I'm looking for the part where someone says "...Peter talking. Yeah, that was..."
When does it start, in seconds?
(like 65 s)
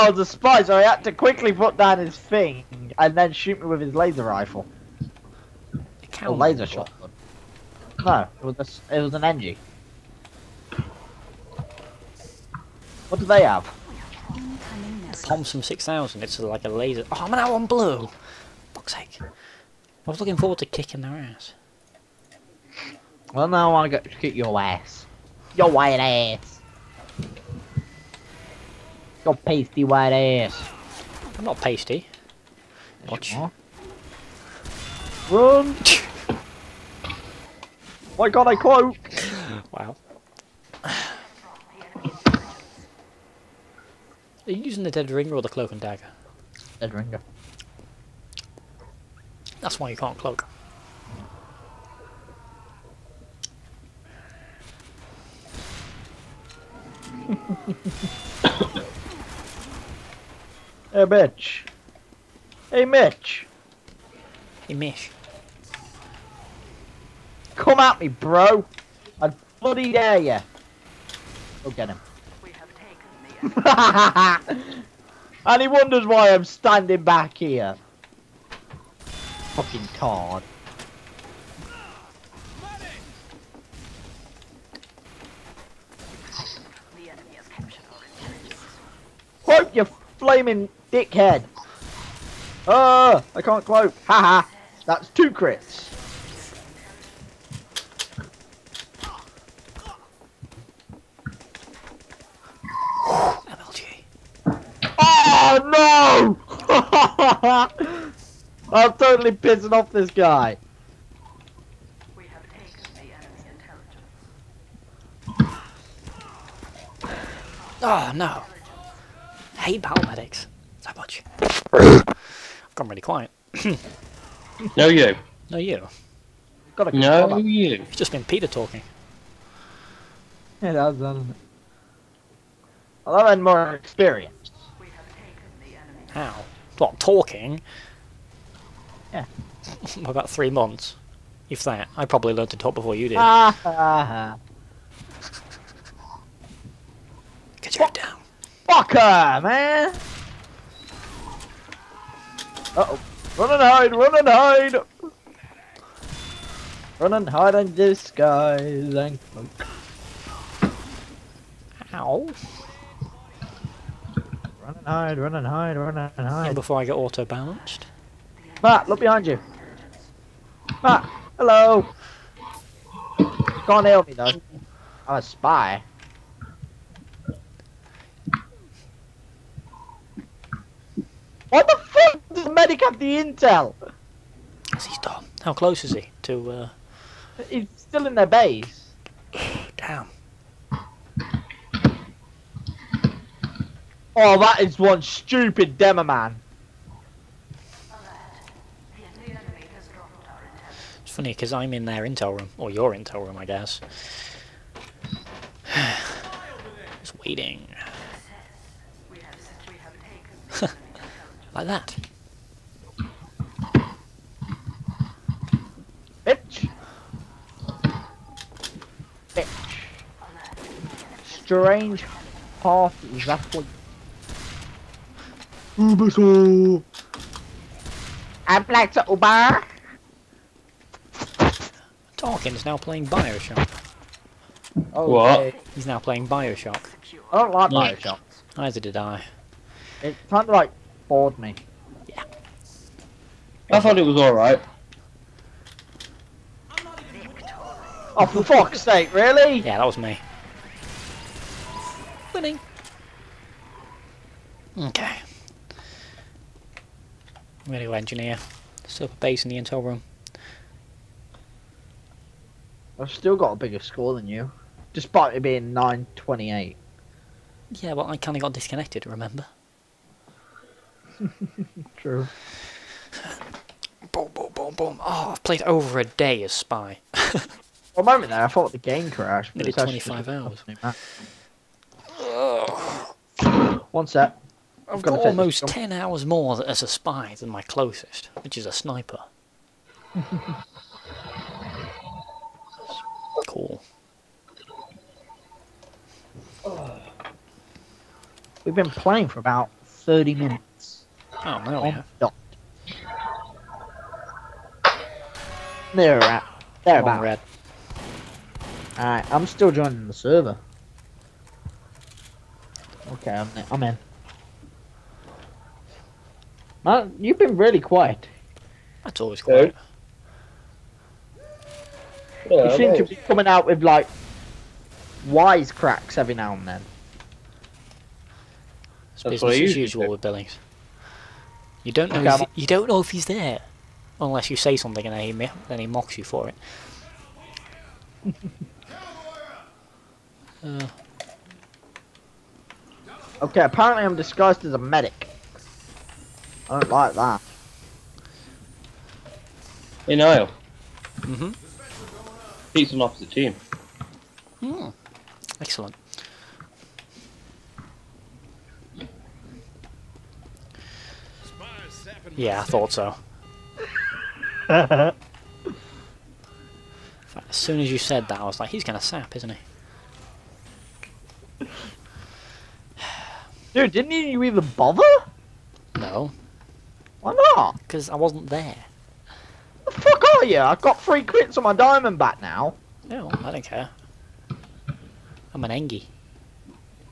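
128 s.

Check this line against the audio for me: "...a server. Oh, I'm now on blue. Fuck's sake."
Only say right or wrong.
wrong.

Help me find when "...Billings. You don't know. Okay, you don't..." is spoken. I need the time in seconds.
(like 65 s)
330 s.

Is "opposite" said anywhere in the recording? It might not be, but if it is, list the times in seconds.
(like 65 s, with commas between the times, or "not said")
353 s.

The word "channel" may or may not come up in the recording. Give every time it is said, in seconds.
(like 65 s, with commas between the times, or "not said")
not said.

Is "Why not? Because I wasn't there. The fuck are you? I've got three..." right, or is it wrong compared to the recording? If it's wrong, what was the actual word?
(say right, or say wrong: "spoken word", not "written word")
right.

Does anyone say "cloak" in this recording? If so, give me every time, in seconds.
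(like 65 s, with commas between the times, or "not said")
45 s, 50 s, 89 s, 93 s, 159 s.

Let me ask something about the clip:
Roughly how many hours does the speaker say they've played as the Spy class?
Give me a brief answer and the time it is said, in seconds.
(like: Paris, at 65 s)
Nearly 25 hours, at 279 s.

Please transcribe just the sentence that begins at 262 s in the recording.
I've still got a bigger score than you, despite it being 928.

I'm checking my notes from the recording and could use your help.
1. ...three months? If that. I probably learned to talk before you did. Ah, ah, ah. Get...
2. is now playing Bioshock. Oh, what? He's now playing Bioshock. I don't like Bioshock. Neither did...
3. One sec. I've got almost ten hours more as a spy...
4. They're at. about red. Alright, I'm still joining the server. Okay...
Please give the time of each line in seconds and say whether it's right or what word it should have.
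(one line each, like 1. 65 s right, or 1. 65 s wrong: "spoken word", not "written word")
1. 140 s right
2. 232 s right
3. 283 s right
4. 305 s right.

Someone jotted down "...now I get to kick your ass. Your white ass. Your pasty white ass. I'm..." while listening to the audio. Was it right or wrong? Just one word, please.
right.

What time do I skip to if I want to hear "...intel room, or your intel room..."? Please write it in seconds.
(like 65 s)
202 s.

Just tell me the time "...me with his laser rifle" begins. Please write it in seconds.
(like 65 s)
3 s.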